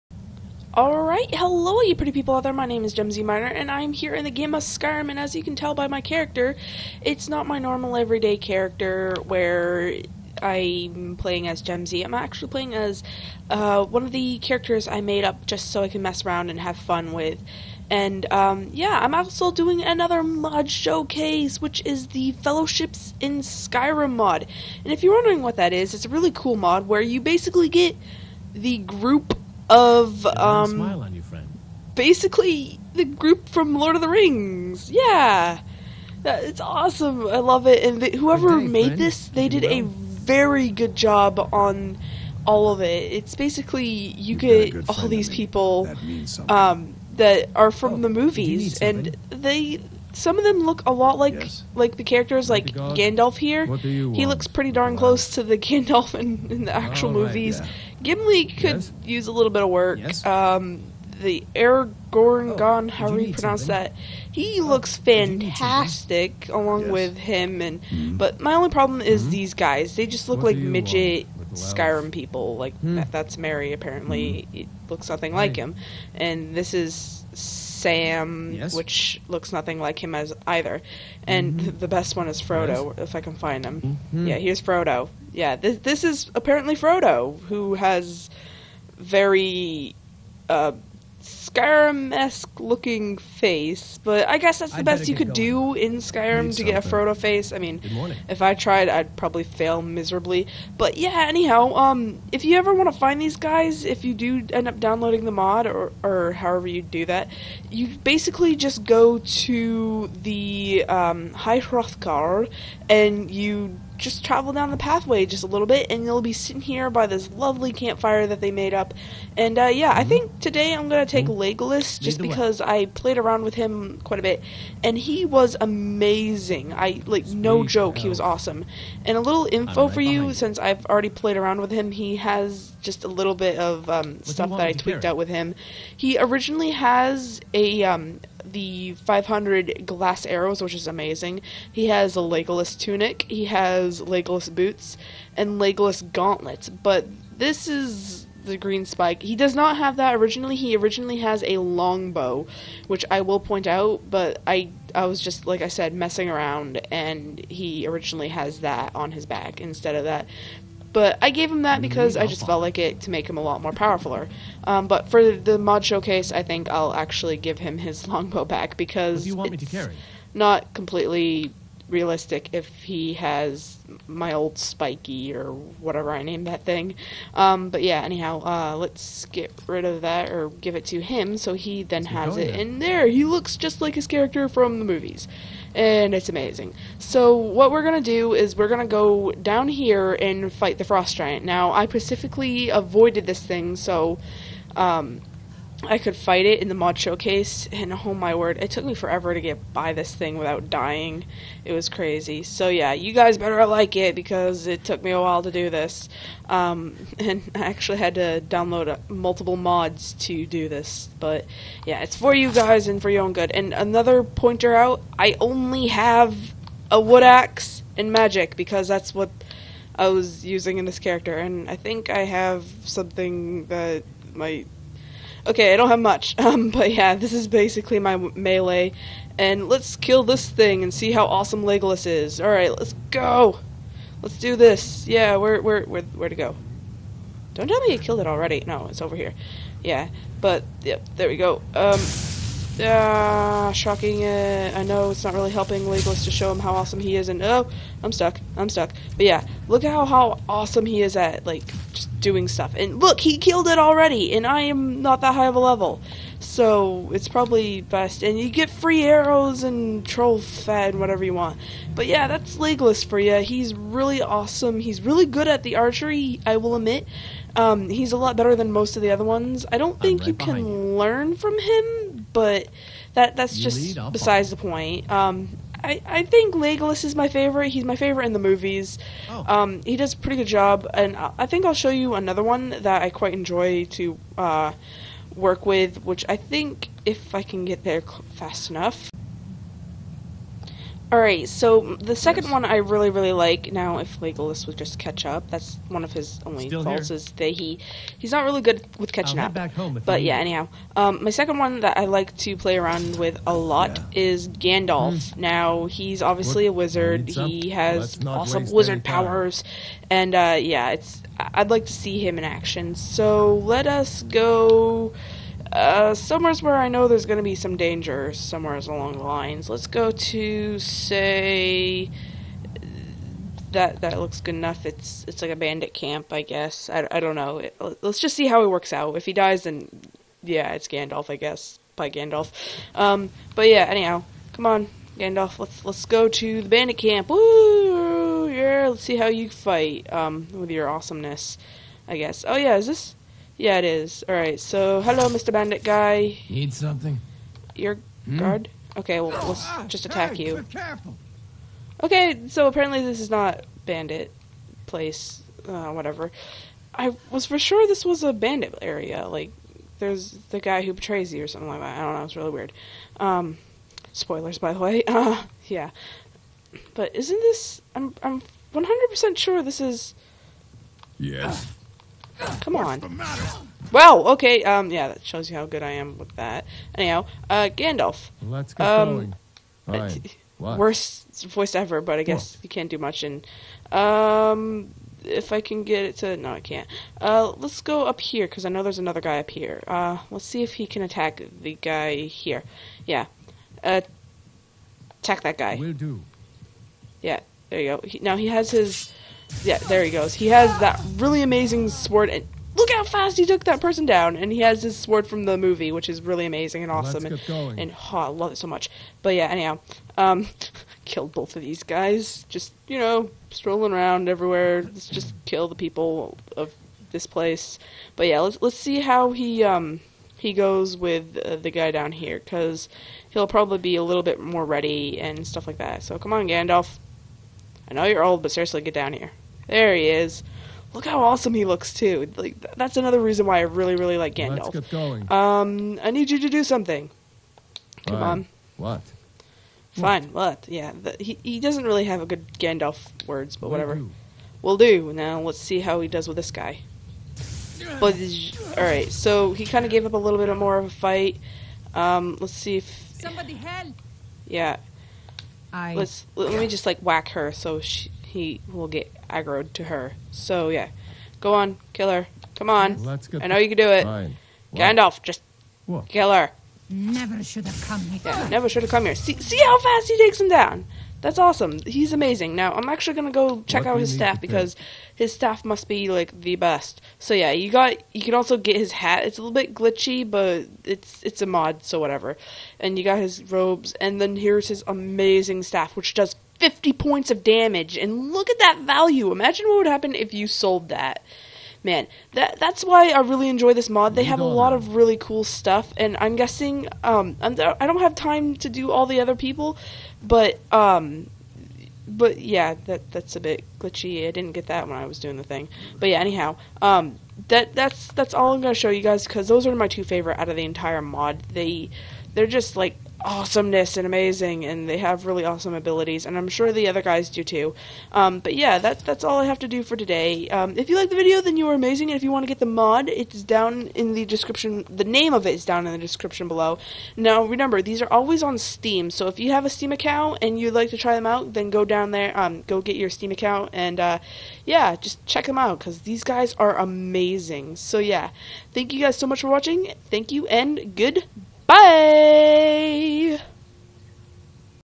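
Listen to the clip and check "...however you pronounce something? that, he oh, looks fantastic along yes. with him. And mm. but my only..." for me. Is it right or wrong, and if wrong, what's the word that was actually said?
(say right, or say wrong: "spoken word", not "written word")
right.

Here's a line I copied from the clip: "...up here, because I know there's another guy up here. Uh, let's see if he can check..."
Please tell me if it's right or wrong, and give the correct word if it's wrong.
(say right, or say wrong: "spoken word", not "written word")
wrong: "attack", not "check".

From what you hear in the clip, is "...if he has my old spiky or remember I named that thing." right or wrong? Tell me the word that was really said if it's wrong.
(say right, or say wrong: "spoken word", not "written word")
wrong: "whatever", not "remember".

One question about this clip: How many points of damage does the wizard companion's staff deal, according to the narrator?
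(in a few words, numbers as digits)
50.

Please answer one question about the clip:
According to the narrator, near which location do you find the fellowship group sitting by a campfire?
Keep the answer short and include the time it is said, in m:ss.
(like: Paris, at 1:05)
High Hrothgar, at 1:51.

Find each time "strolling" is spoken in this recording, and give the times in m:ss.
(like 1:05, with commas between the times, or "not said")
6:53.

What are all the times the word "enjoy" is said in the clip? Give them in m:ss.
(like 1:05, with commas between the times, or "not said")
4:43, 8:13.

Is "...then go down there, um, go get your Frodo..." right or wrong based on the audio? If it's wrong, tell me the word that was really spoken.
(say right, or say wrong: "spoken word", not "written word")
wrong: "Steam", not "Frodo".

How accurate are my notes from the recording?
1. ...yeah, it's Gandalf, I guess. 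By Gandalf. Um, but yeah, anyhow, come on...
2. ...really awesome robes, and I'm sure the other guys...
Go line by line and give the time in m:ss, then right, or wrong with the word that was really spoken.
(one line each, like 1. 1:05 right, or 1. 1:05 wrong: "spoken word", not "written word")
1. 5:30 right
2. 8:35 wrong: "abilities", not "robes".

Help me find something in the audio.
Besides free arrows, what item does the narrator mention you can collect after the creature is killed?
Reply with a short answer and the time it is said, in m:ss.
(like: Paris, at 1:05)
troll fat, at 4:20.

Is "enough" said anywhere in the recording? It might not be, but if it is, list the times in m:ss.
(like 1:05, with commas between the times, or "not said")
4:48, 5:24.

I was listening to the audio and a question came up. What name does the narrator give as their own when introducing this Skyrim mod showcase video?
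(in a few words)
Jemzy Miner.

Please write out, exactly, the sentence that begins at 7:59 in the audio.
It's a little bit glitchy, but it's it's a mod, so whatever.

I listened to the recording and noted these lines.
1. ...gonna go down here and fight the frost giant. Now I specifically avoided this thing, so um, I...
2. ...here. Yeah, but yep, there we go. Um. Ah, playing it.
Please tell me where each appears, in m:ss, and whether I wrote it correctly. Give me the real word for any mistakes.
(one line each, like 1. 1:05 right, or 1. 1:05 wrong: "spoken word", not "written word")
1. 3:08 right
2. 3:59 wrong: "shocking", not "playing".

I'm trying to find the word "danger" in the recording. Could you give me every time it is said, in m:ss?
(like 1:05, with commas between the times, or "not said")
5:17.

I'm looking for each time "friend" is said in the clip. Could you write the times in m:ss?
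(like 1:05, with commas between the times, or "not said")
0:31, 0:38.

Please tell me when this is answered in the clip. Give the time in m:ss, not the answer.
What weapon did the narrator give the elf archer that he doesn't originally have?
2:28.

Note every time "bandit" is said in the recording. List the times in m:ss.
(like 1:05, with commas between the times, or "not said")
5:25, 5:36, 5:45, 5:53, 5:58.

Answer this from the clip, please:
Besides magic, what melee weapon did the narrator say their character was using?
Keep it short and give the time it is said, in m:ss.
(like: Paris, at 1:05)
wood axe, at 3:37.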